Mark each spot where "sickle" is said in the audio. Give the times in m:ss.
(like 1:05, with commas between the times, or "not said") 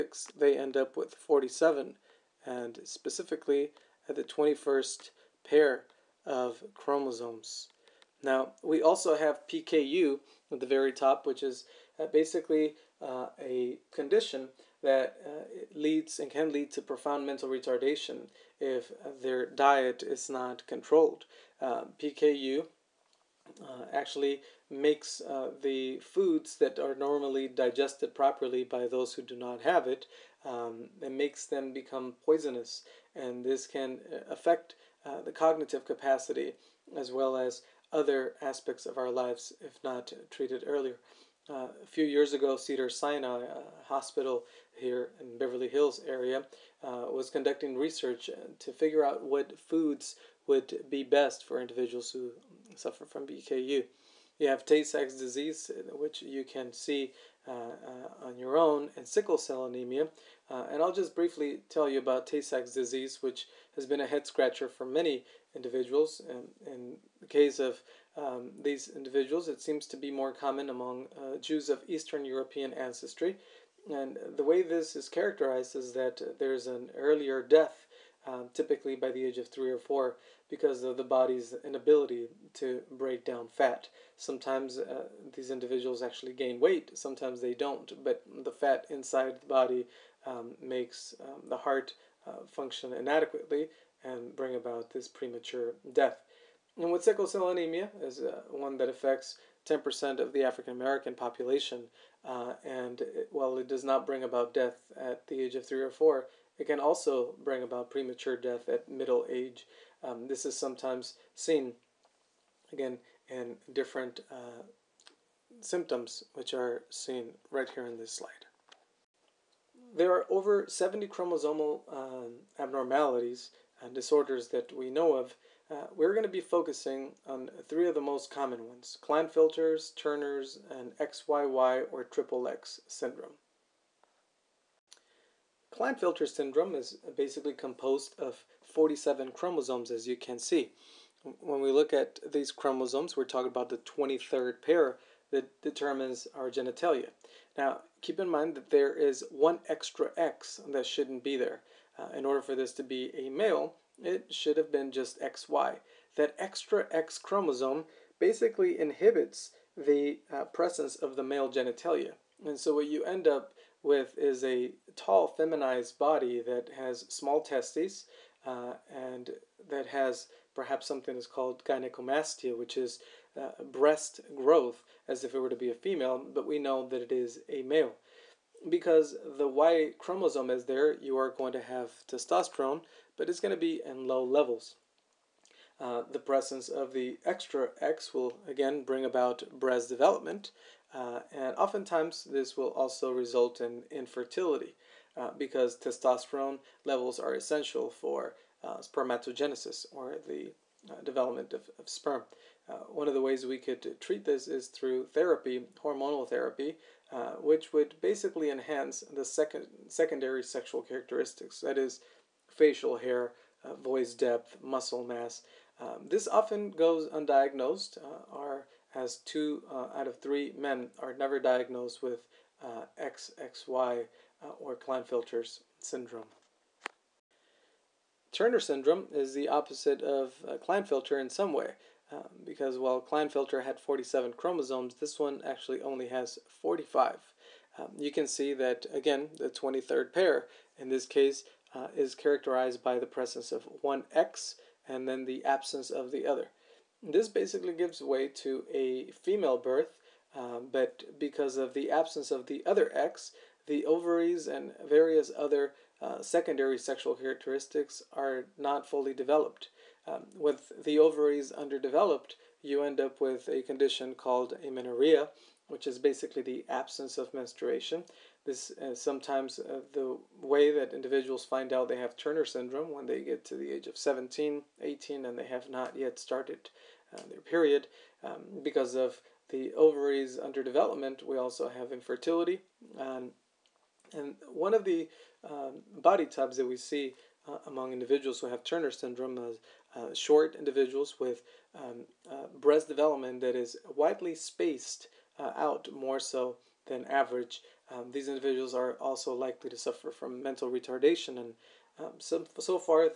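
0:59, 1:37.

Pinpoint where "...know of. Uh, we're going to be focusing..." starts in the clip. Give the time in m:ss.
2:04.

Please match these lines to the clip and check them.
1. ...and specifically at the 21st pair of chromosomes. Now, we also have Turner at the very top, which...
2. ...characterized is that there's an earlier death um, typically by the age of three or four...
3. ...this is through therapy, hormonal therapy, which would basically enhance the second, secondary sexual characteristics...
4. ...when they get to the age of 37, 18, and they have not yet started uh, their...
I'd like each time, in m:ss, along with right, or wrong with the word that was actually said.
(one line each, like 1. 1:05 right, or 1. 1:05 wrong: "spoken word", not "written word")
1. 0:02 wrong: "PKU", not "Turner"
2. 1:15 right
3. 3:24 right
4. 4:32 wrong: "17", not "37".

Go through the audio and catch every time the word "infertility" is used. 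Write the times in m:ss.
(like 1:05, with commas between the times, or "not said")
3:13, 4:41.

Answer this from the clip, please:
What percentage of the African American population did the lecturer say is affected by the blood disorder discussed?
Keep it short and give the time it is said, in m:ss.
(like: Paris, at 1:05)
10%, at 1:39.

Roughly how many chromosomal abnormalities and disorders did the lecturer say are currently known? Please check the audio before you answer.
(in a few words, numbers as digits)
over 70.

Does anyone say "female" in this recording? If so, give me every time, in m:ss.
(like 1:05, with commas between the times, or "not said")
2:55, 4:09.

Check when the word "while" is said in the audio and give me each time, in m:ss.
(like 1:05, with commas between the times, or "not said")
1:43, 3:52.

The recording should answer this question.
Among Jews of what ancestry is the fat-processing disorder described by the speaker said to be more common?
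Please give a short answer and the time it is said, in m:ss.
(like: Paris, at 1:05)
Eastern European, at 1:11.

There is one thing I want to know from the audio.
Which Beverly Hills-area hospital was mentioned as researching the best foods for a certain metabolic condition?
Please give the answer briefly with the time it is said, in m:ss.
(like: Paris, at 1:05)
Cedar Sinai Hospital, at 0:42.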